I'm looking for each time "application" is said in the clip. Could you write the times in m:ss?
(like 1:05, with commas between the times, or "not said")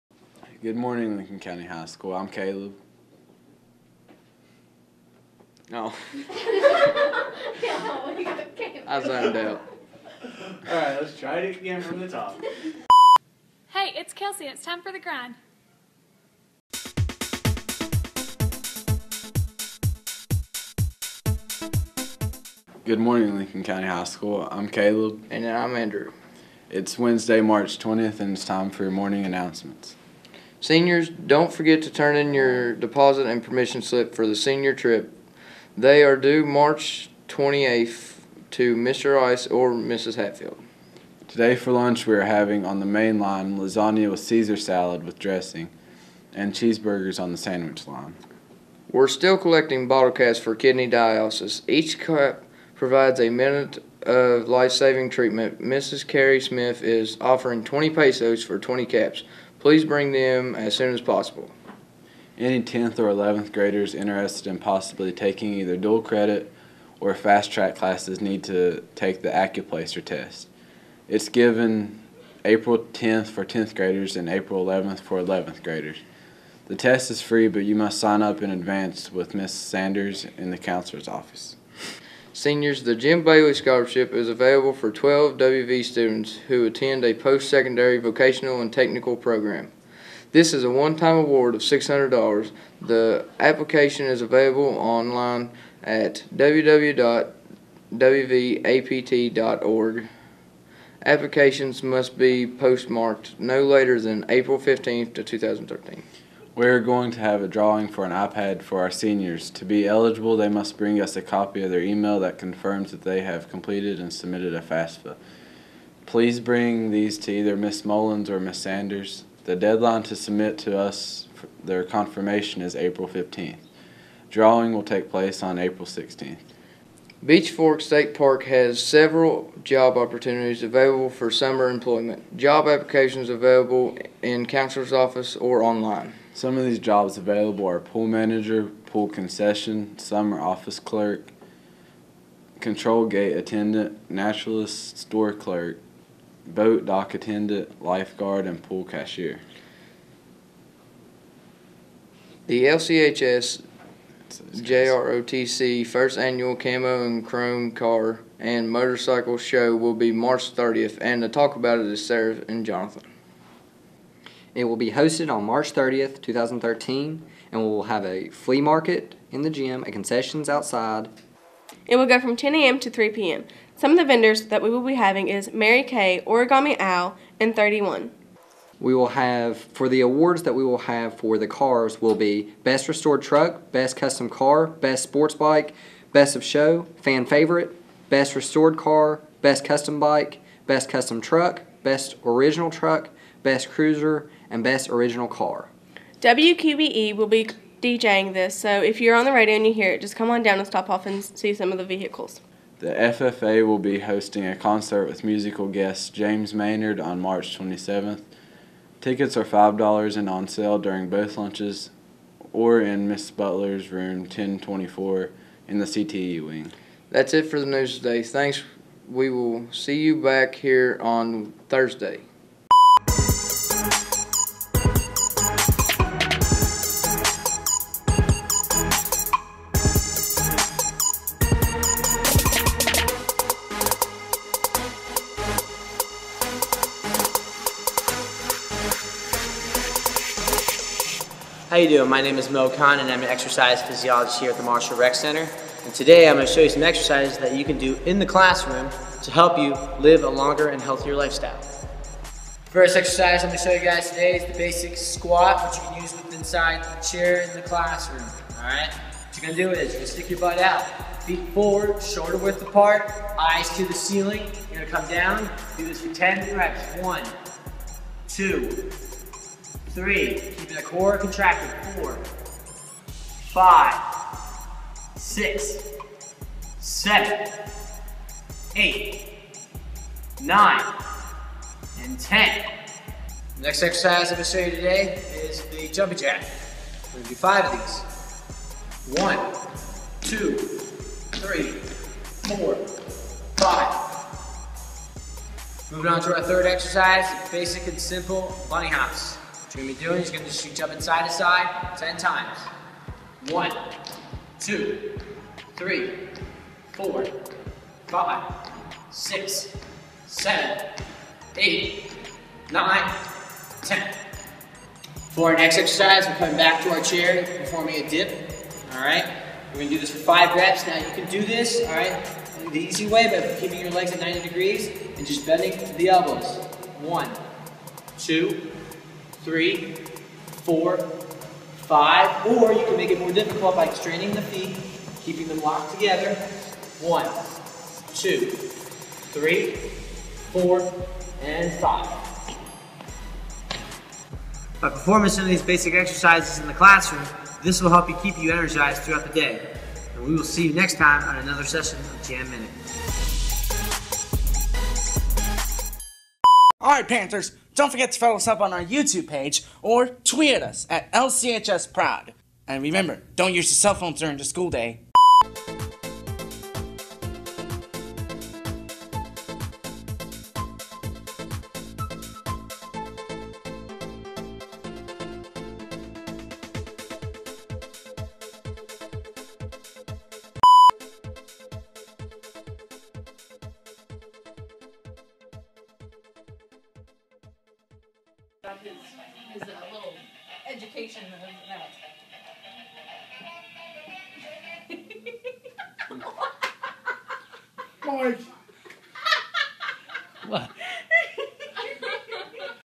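1:33, 1:41, 2:12.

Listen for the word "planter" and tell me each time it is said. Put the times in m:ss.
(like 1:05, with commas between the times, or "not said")
not said.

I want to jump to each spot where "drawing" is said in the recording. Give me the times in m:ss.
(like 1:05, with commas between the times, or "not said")
1:47, 2:04.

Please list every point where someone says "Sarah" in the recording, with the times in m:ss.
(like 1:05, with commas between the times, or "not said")
2:42.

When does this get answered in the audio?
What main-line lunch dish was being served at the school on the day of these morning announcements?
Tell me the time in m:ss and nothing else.
0:43.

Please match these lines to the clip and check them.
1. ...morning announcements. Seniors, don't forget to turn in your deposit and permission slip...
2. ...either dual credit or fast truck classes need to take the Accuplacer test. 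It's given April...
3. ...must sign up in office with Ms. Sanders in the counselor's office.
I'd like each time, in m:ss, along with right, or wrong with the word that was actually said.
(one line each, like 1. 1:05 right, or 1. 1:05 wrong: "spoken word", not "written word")
1. 0:28 right
2. 1:05 wrong: "track", not "truck"
3. 1:17 wrong: "advance", not "office".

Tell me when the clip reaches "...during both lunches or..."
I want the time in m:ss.
3:30.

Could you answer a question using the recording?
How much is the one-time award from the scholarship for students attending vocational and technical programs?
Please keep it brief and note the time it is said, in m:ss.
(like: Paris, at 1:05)
$600, at 1:31.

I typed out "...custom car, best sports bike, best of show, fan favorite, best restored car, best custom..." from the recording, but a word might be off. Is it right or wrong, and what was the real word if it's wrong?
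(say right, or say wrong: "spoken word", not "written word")
right.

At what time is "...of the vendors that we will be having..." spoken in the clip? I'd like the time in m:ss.
2:53.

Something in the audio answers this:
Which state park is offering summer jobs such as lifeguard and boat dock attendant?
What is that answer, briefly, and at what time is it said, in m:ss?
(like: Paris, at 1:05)
Beach Fork State Park, at 2:07.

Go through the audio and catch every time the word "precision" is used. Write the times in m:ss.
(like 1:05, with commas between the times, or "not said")
not said.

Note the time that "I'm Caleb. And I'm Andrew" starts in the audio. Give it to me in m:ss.
0:24.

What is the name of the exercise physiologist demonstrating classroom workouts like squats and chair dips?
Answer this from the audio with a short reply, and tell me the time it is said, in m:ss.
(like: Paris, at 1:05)
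Mo Khan, at 4:02.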